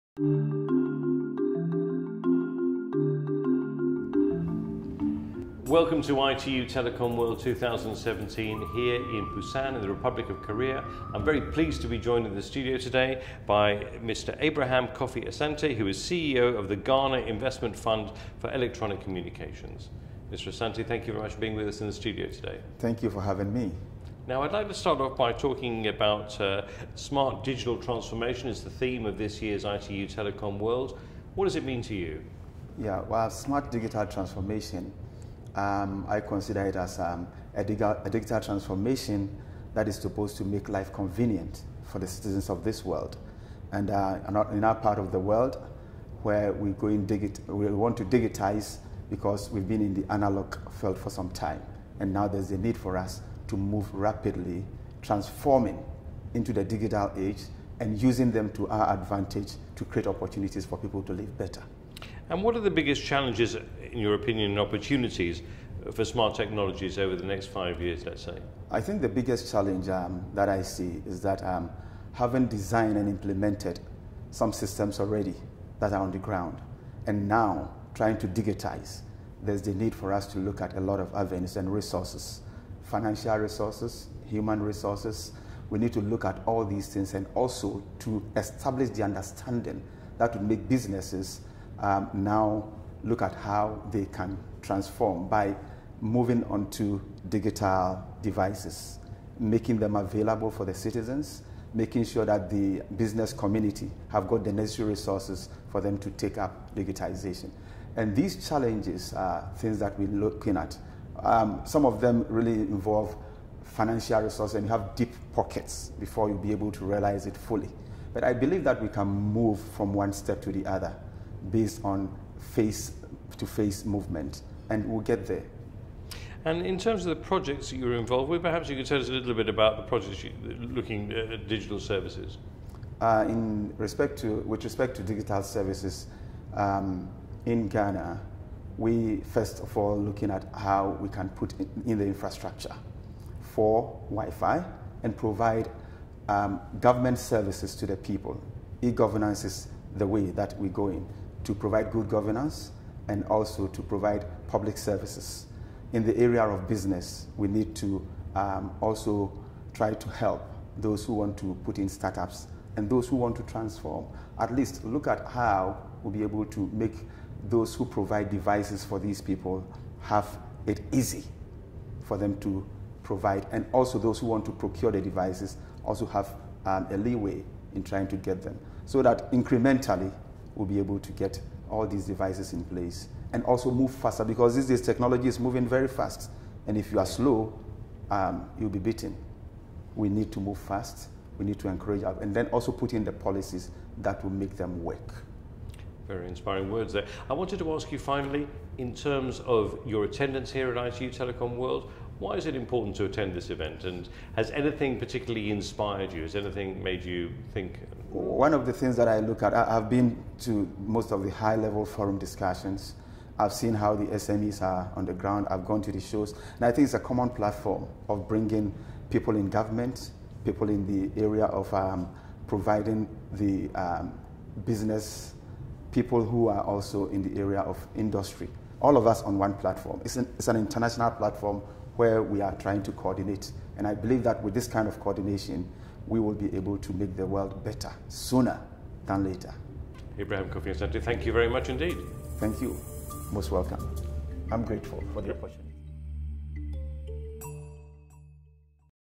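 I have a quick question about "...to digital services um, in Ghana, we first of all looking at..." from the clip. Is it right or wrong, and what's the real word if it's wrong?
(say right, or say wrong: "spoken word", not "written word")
right.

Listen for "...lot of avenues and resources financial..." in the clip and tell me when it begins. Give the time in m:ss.
1:20.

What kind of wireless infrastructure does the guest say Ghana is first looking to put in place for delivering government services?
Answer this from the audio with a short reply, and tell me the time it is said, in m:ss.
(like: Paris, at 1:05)
Wi-Fi, at 2:24.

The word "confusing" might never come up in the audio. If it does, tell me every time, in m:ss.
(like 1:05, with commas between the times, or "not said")
not said.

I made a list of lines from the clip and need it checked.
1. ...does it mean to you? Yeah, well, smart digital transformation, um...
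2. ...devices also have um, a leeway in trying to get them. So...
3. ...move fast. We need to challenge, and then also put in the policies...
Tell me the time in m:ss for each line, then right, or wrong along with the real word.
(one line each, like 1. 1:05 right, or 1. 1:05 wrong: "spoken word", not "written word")
1. 0:31 right
2. 2:55 right
3. 3:10 wrong: "encourage", not "challenge".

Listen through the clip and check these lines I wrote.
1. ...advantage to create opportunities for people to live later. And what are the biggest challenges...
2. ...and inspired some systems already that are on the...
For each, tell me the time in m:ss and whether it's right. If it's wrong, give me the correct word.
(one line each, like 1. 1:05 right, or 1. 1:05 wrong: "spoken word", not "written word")
1. 0:58 wrong: "better", not "later"
2. 1:12 wrong: "implemented", not "inspired".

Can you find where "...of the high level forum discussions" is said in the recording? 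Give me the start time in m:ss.
3:31.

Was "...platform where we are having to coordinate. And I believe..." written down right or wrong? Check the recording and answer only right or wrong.
wrong.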